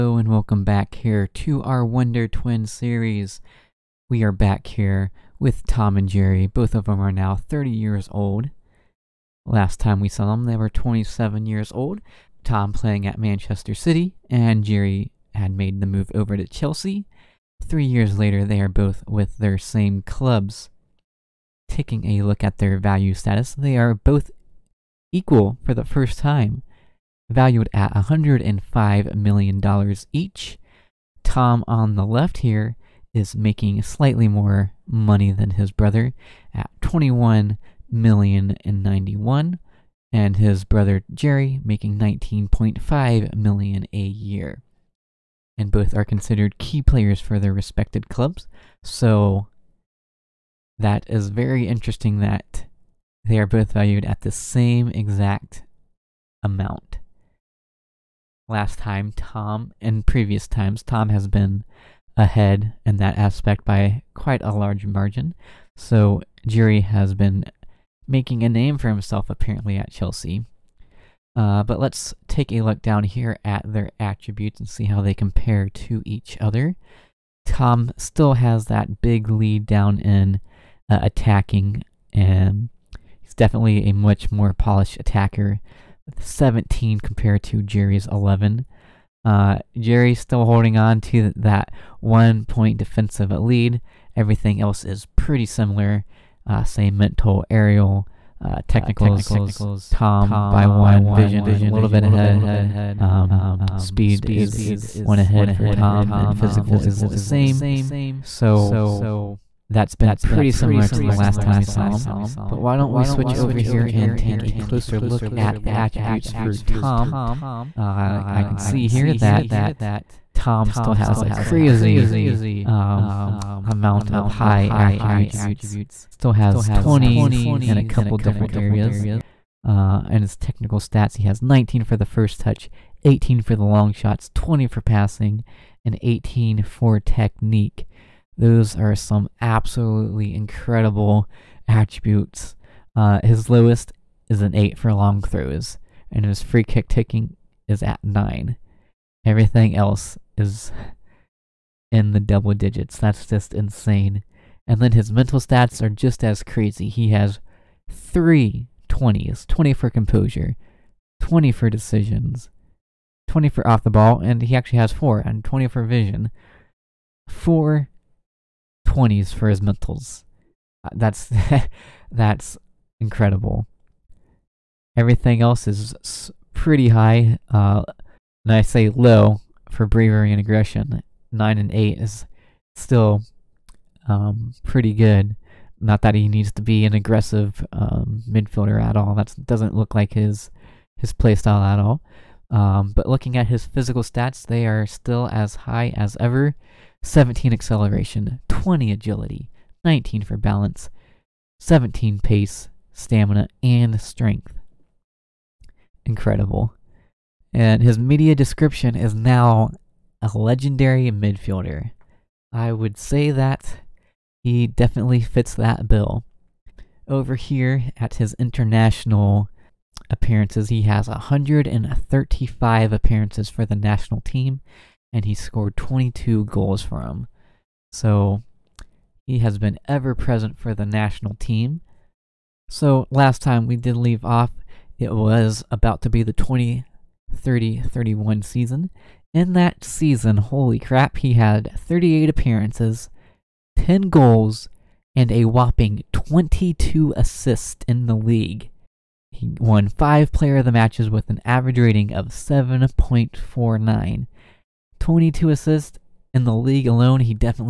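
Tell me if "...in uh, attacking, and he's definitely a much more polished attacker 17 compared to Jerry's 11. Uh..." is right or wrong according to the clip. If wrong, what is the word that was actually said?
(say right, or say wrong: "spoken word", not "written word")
right.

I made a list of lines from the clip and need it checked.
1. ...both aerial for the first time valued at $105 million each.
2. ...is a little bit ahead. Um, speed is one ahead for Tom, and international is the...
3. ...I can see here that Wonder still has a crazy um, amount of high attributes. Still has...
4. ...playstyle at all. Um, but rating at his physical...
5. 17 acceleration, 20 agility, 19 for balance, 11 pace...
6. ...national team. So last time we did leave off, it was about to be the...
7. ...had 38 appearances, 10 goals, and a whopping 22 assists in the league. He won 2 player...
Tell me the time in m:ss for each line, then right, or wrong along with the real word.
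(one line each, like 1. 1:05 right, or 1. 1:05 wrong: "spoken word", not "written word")
1. 0:23 wrong: "equal", not "aerial"
2. 1:41 wrong: "physical", not "international"
3. 1:58 wrong: "Tom", not "Wonder"
4. 3:11 wrong: "looking", not "rating"
5. 3:17 wrong: "17", not "11"
6. 3:50 right
7. 4:01 wrong: "5", not "2".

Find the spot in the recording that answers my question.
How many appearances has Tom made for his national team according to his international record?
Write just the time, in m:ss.
3:41.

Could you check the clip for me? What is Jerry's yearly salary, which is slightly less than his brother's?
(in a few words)
19.5 million.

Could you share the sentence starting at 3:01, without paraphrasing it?
Nine and eight is still um, pretty good.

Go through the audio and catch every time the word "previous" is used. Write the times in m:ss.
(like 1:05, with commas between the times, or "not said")
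1:00.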